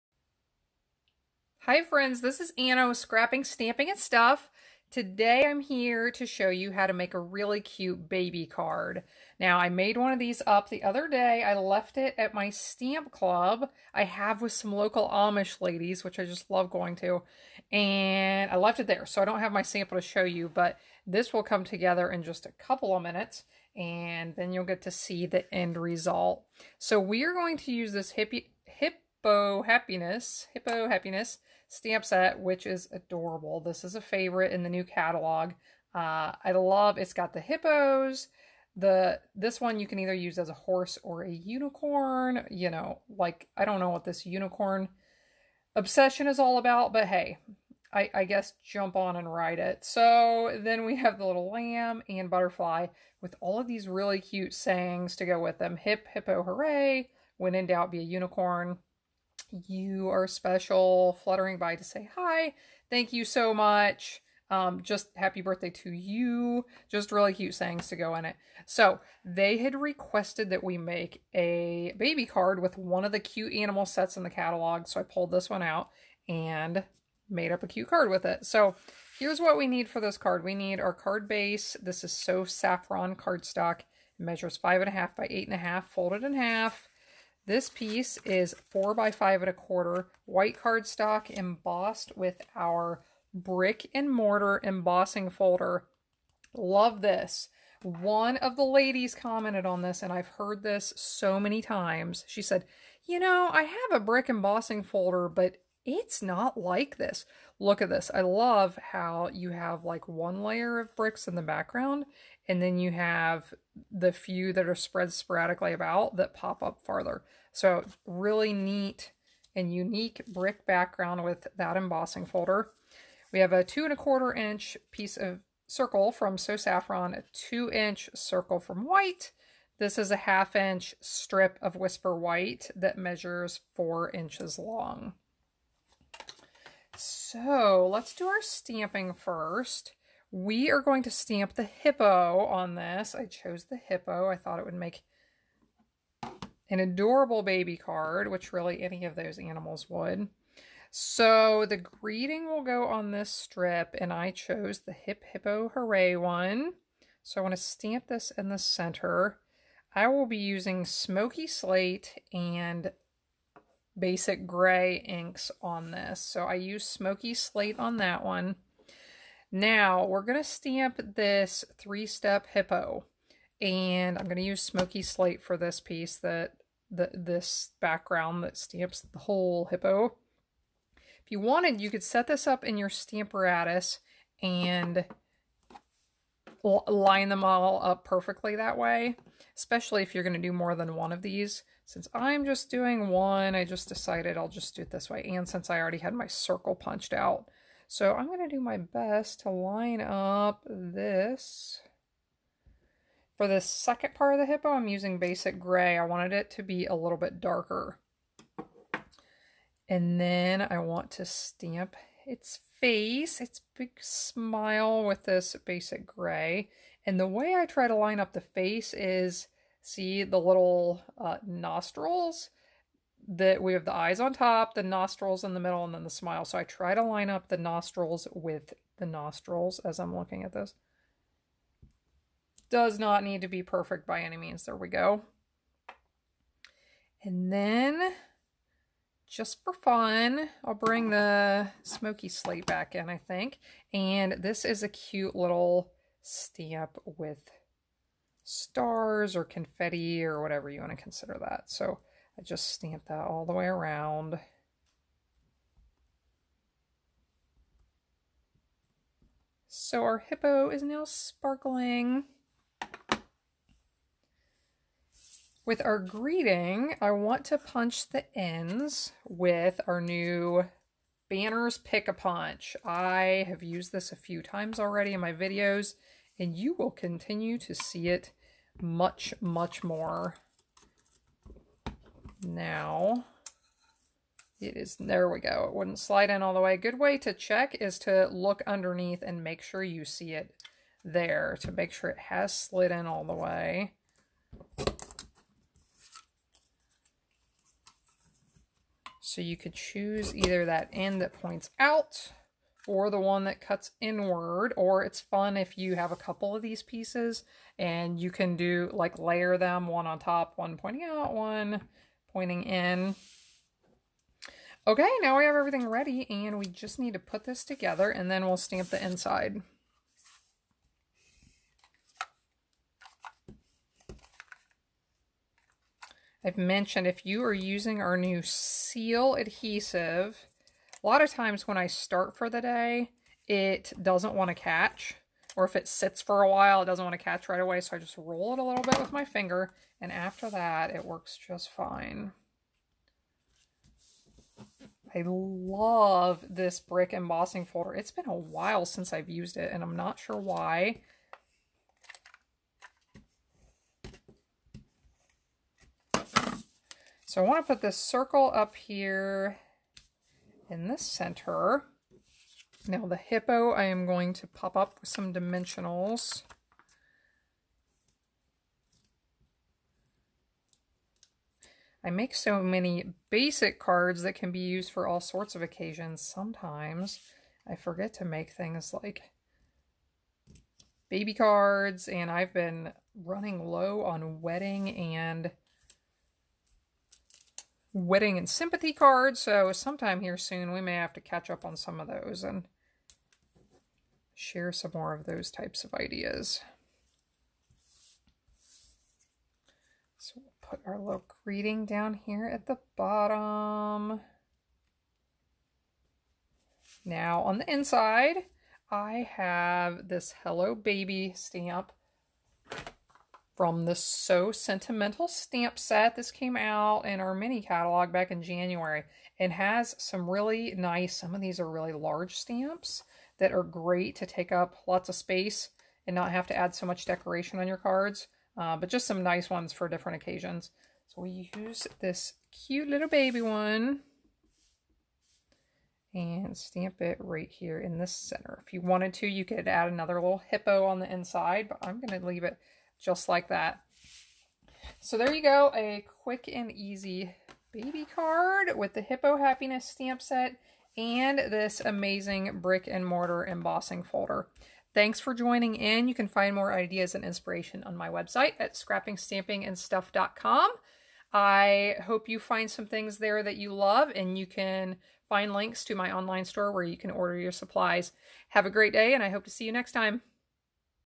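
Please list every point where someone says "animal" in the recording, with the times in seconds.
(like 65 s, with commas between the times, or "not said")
73 s, 149 s.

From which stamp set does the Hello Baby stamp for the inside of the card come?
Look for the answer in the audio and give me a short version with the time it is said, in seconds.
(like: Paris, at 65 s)
So Sentimental, at 413 s.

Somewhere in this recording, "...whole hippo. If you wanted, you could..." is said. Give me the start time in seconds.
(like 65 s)
179 s.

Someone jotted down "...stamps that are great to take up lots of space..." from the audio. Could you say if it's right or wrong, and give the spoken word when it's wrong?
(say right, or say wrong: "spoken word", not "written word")
right.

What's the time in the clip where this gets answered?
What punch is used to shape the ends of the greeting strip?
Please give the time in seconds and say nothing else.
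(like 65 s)
271 s.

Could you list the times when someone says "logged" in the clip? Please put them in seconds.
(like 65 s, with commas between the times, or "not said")
not said.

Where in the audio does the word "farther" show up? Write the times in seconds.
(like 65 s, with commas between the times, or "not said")
116 s.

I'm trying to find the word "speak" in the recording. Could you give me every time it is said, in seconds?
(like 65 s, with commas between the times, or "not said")
not said.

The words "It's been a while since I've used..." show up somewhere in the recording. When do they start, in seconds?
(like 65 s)
347 s.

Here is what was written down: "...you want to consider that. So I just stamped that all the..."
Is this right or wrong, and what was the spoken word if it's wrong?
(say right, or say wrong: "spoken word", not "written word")
right.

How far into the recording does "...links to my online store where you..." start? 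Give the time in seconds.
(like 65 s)
465 s.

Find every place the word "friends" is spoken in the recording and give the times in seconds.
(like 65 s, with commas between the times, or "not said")
1 s.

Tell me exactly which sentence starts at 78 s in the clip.
So here's what we need for this card.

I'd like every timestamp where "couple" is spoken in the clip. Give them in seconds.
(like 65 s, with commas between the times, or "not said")
22 s, 306 s.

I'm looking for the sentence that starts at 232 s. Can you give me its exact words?
Does not need to be perfect by any means.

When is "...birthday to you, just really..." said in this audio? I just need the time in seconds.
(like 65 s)
65 s.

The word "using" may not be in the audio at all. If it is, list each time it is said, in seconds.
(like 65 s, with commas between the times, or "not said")
160 s, 204 s, 327 s.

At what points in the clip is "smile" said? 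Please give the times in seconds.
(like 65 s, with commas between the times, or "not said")
214 s, 226 s.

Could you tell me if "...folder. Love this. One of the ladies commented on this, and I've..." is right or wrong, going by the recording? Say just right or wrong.
right.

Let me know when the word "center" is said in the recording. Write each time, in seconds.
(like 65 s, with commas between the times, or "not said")
158 s, 360 s, 438 s.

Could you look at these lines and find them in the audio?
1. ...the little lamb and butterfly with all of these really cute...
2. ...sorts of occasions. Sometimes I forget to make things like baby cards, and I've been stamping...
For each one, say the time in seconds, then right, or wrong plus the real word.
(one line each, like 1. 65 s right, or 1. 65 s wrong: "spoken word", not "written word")
1. 51 s right
2. 375 s wrong: "running", not "stamping".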